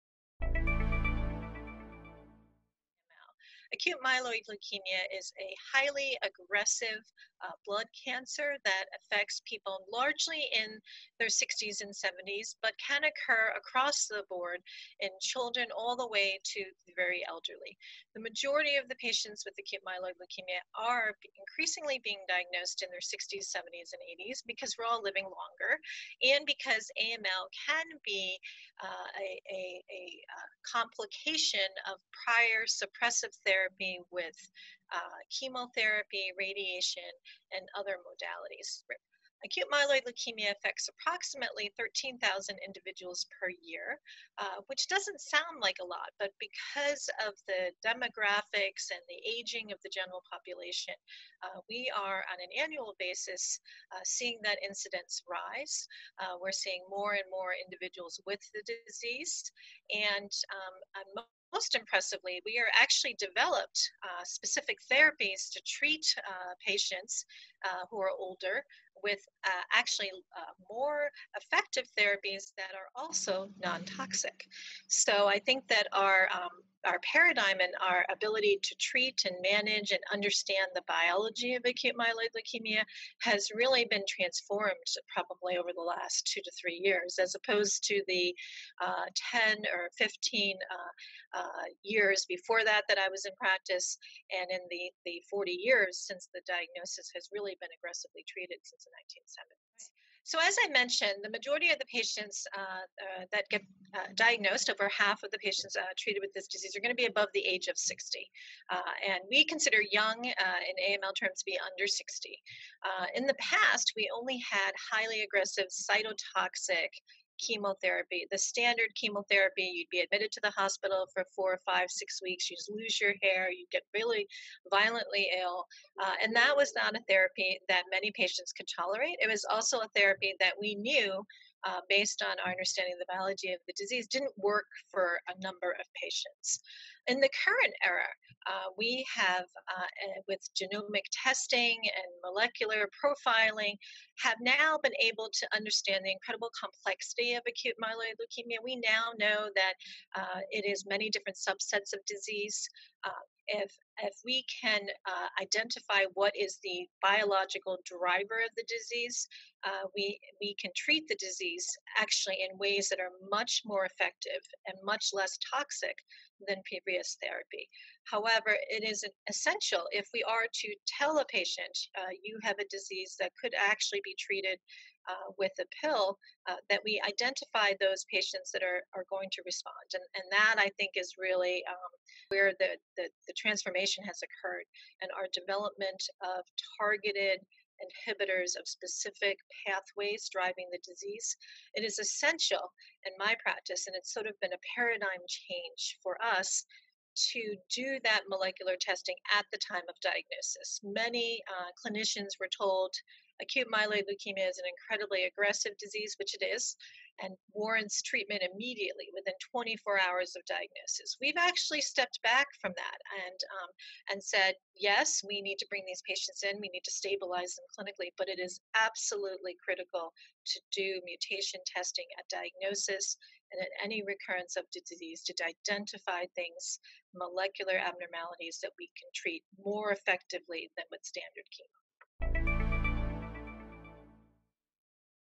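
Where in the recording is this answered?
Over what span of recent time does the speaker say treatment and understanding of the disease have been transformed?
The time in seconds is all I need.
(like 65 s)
86 s.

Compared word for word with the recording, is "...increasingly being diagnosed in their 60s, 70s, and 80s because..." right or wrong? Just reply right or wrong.
right.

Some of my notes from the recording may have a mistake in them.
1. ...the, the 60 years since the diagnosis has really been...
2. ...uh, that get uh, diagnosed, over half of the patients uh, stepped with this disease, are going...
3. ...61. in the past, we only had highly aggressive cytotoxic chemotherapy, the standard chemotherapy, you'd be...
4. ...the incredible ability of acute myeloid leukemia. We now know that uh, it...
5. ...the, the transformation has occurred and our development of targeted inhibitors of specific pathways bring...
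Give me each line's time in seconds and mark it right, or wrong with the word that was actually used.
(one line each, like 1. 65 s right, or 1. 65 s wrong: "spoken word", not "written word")
1. 94 s wrong: "40", not "60"
2. 102 s wrong: "treated", not "stepped"
3. 111 s wrong: "60", not "61"
4. 146 s wrong: "complexity", not "ability"
5. 182 s wrong: "driving", not "bring".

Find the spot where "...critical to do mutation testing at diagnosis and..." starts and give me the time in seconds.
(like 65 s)
219 s.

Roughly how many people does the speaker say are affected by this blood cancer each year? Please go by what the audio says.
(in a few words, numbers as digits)
13,000.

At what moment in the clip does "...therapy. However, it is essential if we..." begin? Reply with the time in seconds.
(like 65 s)
167 s.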